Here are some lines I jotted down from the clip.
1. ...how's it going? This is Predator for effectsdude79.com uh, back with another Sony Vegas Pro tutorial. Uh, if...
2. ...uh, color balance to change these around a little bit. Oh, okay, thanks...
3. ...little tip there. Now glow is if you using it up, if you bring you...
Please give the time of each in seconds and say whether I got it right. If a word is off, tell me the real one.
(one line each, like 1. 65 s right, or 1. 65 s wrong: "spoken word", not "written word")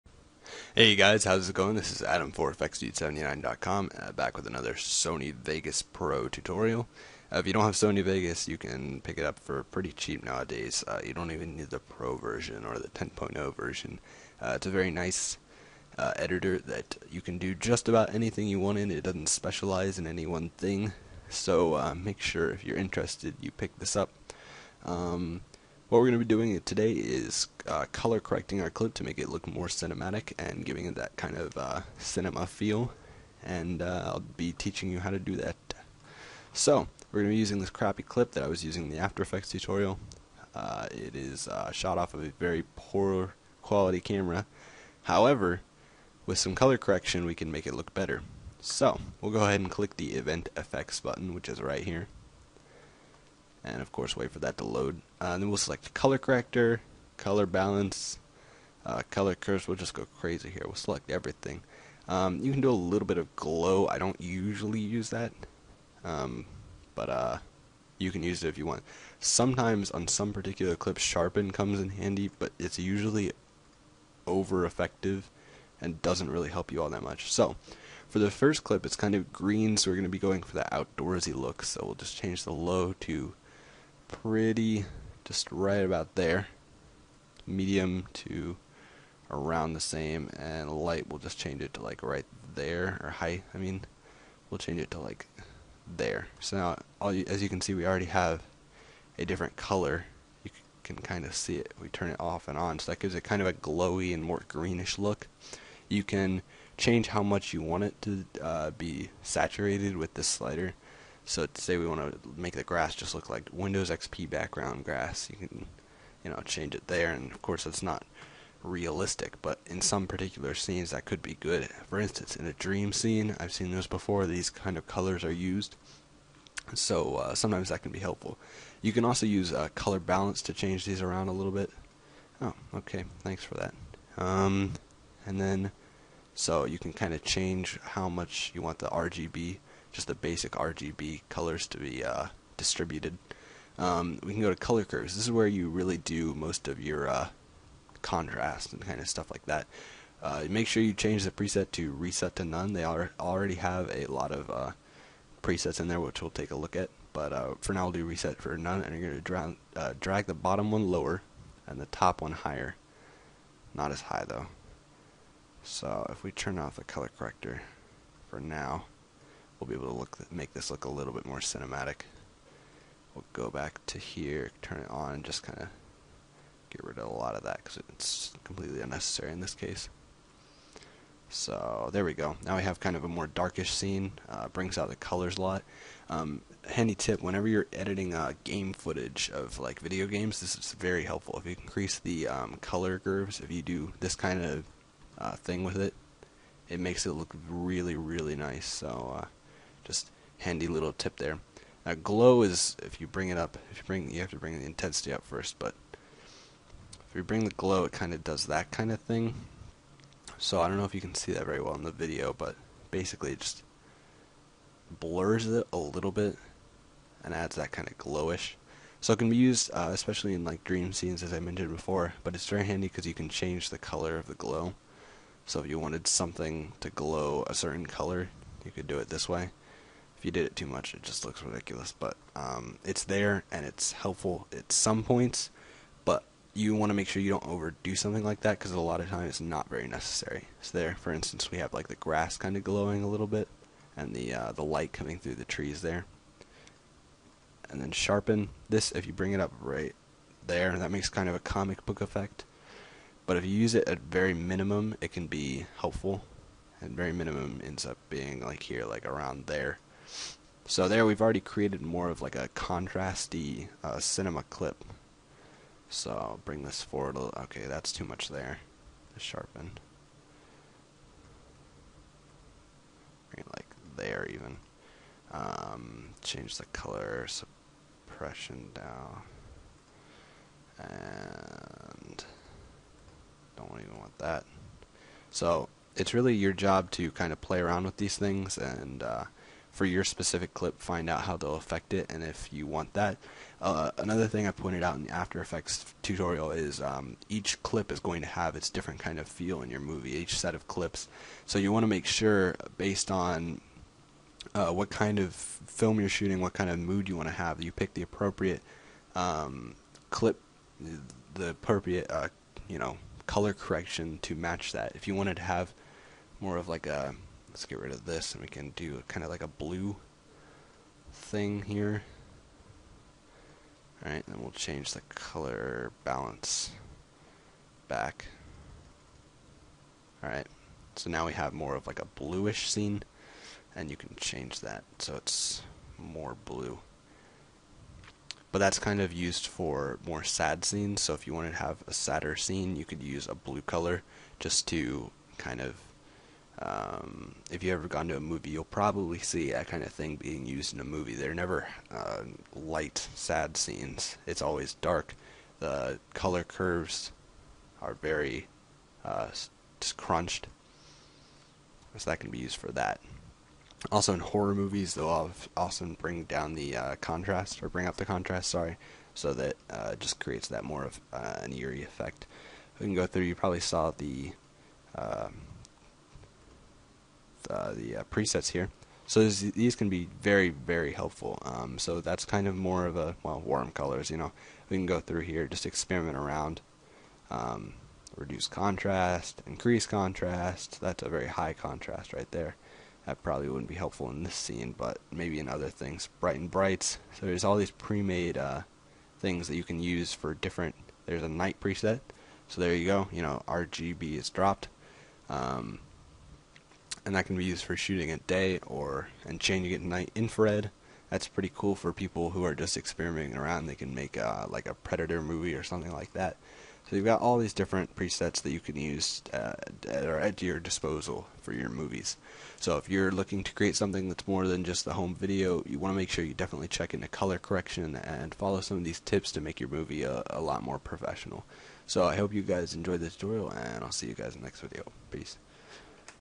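1. 1 s wrong: "Adam", not "Predator"
2. 129 s right
3. 200 s wrong: "bring", not "using".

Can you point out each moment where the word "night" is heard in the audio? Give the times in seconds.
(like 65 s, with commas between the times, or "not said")
401 s, 409 s.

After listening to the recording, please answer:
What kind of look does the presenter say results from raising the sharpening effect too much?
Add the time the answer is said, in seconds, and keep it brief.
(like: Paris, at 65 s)
comic book effect, at 251 s.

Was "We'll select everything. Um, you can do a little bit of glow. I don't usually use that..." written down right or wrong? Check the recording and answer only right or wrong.
right.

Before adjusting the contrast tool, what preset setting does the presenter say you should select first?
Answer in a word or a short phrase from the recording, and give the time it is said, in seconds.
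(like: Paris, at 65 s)
reset to none, at 151 s.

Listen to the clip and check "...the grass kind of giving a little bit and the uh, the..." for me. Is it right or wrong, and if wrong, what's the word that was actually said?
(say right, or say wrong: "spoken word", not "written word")
wrong: "glowing", not "giving".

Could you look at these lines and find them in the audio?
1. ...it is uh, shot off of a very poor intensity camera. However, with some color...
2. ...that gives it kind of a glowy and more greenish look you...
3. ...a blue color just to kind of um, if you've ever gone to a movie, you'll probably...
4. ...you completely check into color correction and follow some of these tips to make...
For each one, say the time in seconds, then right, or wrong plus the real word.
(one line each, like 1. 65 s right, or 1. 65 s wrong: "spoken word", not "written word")
1. 40 s wrong: "quality", not "intensity"
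2. 102 s right
3. 343 s right
4. 426 s wrong: "definitely", not "completely".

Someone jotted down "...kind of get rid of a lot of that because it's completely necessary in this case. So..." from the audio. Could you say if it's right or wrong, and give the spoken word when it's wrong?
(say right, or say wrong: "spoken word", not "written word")
wrong: "unnecessary", not "necessary".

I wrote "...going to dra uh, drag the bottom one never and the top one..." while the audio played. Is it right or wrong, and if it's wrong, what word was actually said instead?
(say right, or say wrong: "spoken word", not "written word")
wrong: "lower", not "never".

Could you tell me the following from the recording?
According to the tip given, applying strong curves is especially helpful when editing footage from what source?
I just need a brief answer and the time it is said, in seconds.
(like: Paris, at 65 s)
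video games, at 189 s.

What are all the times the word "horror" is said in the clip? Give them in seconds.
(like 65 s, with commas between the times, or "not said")
364 s.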